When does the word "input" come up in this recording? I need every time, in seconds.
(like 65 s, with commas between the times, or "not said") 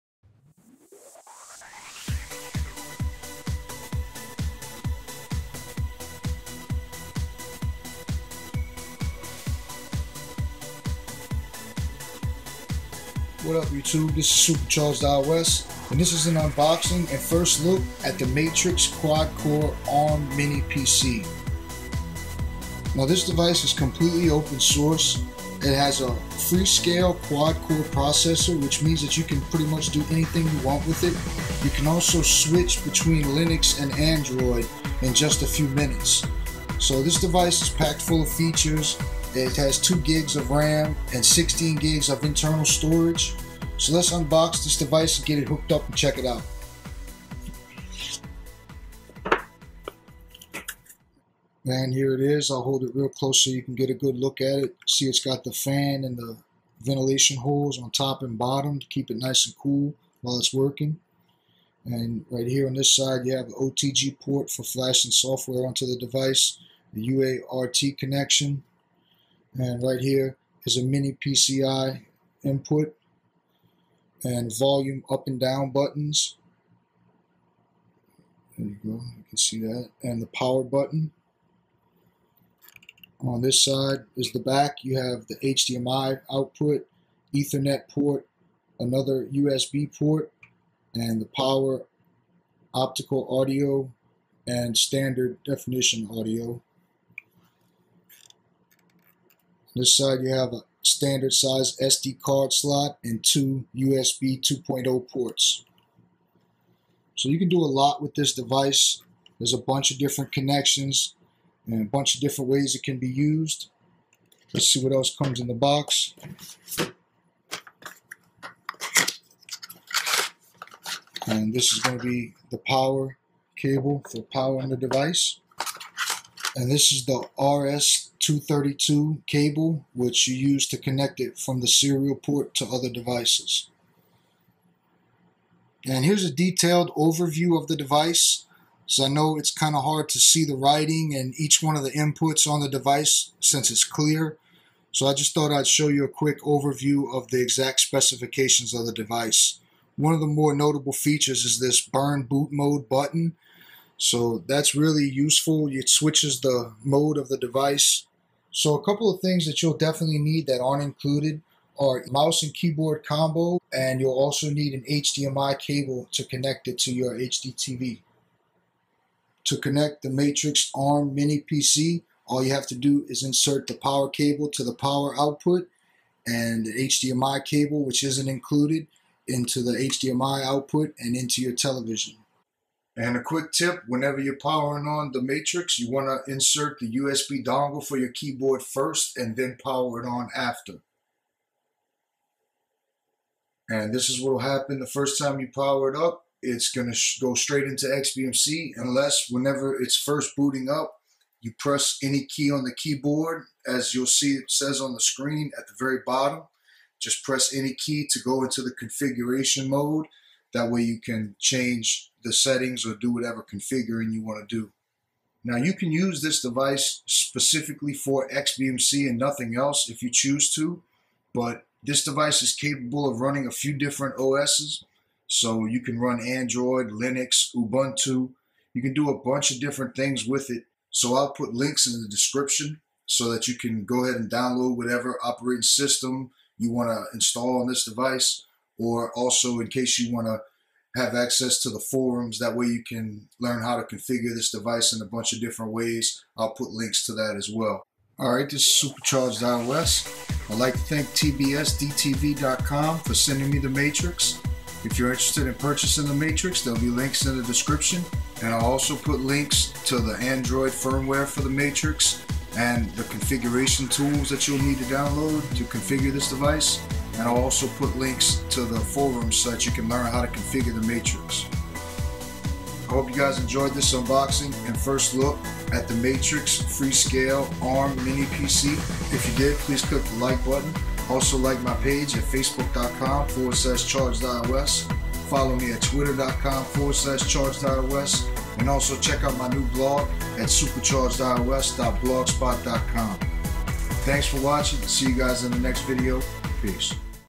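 72 s, 141 s.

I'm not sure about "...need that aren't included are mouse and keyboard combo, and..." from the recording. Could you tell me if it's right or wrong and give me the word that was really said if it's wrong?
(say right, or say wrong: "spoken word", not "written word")
right.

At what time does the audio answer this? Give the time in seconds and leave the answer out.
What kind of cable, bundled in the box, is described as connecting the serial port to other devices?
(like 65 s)
127 s.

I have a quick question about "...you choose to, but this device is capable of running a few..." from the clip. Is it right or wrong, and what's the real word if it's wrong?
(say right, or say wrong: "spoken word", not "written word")
right.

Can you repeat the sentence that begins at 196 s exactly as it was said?
It's going to go straight into XBMC unless whenever it's first booting up, you press any key on the keyboard.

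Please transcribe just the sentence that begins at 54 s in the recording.
See it's got the fan and the ventilation holes on top and bottom to keep it nice and cool while it's working.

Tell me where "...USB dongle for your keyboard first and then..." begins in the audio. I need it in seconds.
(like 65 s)
186 s.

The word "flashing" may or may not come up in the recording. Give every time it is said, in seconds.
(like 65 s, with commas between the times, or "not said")
64 s.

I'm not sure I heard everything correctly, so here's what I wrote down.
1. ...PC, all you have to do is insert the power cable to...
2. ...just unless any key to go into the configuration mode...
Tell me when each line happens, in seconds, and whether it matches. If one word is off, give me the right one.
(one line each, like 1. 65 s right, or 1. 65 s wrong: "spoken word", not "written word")
1. 171 s right
2. 206 s wrong: "press", not "unless".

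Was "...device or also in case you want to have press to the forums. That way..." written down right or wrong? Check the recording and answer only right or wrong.
wrong.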